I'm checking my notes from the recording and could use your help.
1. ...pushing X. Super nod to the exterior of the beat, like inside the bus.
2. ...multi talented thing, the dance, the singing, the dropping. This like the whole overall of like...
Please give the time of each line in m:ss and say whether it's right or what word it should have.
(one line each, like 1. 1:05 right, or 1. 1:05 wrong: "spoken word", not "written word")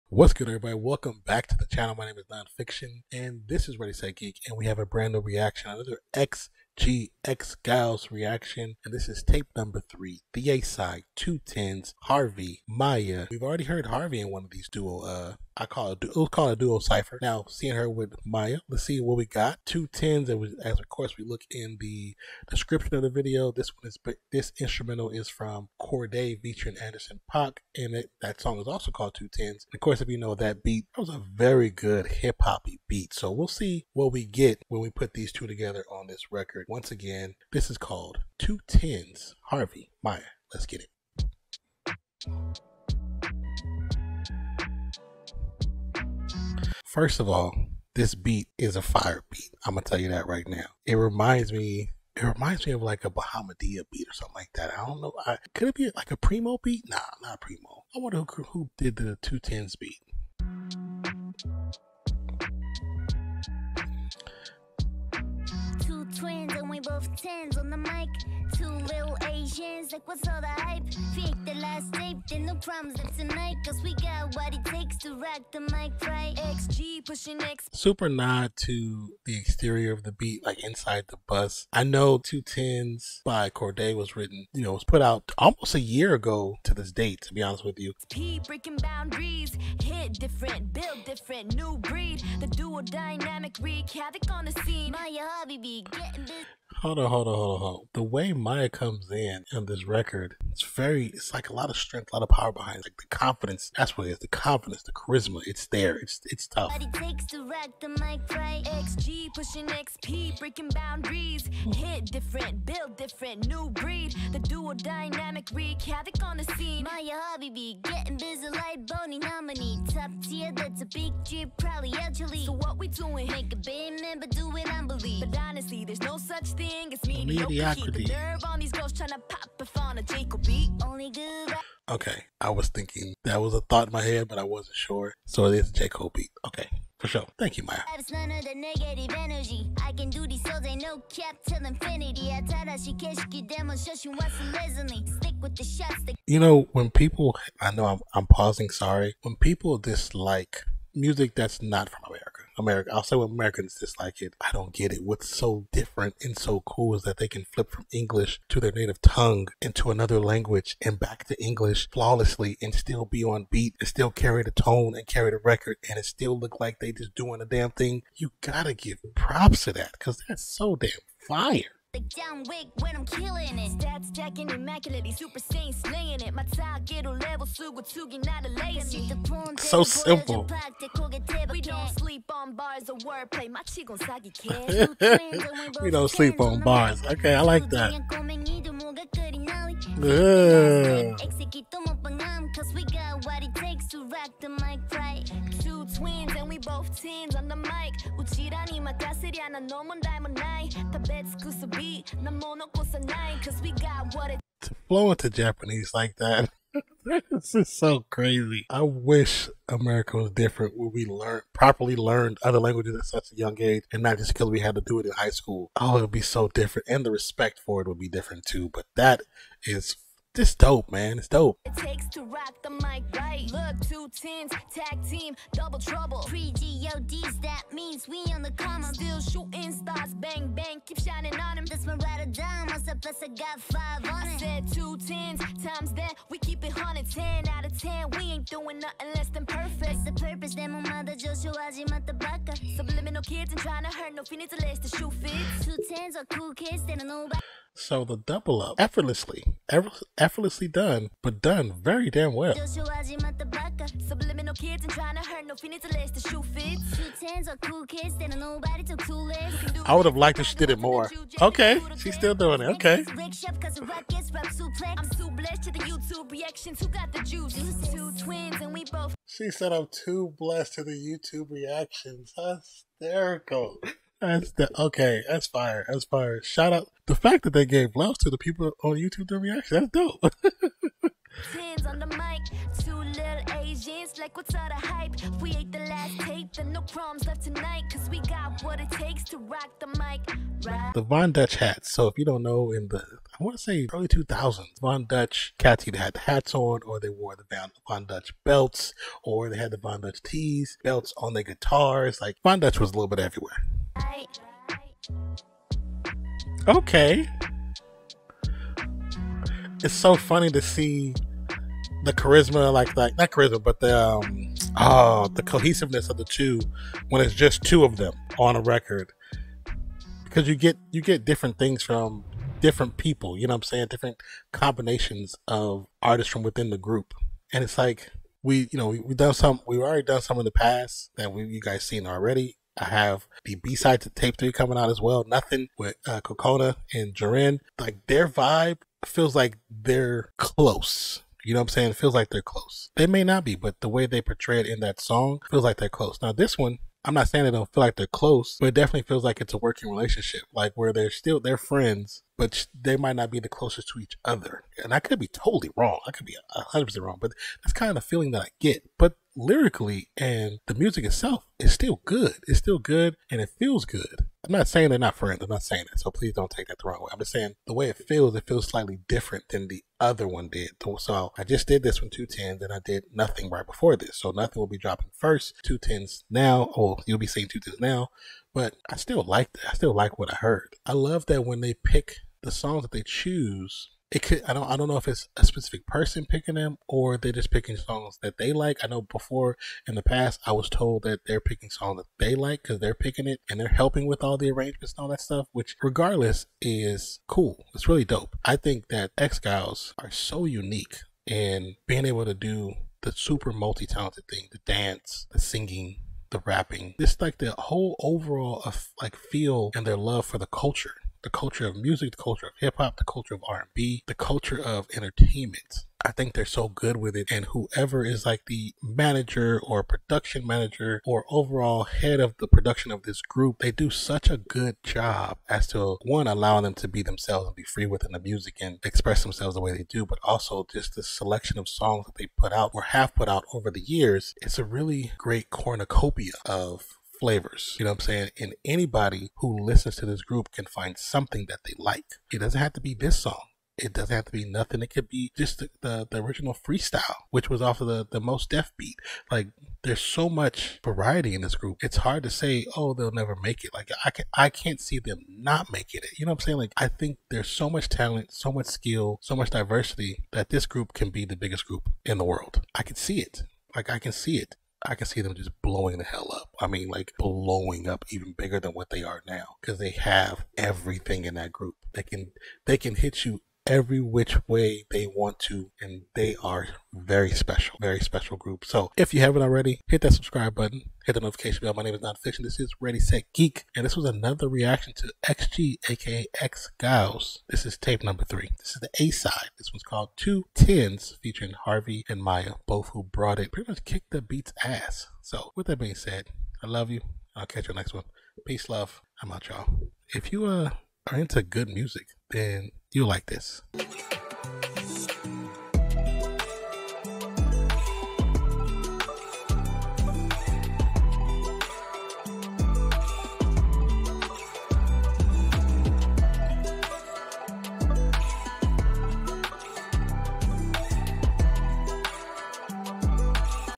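1. 1:17 right
2. 6:43 wrong: "rapping", not "dropping".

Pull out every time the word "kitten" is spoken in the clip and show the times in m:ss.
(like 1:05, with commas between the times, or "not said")
not said.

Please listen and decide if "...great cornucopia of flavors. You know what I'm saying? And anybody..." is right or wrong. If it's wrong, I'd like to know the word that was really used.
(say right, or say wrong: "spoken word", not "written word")
right.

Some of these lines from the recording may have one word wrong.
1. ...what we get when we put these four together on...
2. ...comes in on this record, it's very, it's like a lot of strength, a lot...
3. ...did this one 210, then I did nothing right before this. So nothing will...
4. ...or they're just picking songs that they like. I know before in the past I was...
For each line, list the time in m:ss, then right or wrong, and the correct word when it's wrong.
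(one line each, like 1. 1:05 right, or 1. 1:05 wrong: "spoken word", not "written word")
1. 0:33 wrong: "two", not "four"
2. 1:38 right
3. 6:11 right
4. 6:26 right.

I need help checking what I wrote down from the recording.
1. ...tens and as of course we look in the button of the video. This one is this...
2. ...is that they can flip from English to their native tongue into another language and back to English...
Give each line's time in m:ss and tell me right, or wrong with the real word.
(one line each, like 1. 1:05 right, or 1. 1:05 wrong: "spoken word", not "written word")
1. 0:19 wrong: "description", not "button"
2. 2:36 right.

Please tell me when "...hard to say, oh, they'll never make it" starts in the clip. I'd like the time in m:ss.
7:31.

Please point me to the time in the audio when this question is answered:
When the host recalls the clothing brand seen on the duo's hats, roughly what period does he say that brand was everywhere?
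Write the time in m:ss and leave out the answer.
4:53.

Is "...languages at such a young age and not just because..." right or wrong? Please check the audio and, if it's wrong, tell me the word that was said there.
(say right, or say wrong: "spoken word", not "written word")
right.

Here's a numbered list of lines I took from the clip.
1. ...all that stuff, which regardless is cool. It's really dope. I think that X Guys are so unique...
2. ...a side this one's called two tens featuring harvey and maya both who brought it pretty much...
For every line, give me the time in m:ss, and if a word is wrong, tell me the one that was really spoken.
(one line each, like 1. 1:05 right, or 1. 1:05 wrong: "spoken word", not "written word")
1. 6:35 right
2. 8:09 right.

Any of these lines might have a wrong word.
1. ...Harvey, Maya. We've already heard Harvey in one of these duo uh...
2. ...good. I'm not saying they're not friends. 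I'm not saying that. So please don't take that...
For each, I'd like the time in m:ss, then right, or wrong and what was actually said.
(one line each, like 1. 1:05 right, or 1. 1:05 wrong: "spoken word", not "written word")
1. 0:12 right
2. 6:03 right.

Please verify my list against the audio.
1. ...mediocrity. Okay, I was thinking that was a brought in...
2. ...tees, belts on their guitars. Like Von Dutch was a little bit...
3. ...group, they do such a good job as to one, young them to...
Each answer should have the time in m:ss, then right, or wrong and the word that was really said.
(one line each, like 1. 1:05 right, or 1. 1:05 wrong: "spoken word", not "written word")
1. 2:07 wrong: "thought", not "brought"
2. 5:00 right
3. 7:03 wrong: "allowing", not "young".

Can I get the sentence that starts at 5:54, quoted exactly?
And I could be totally wrong.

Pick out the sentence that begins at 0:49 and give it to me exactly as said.
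I'm gonna tell you that right now.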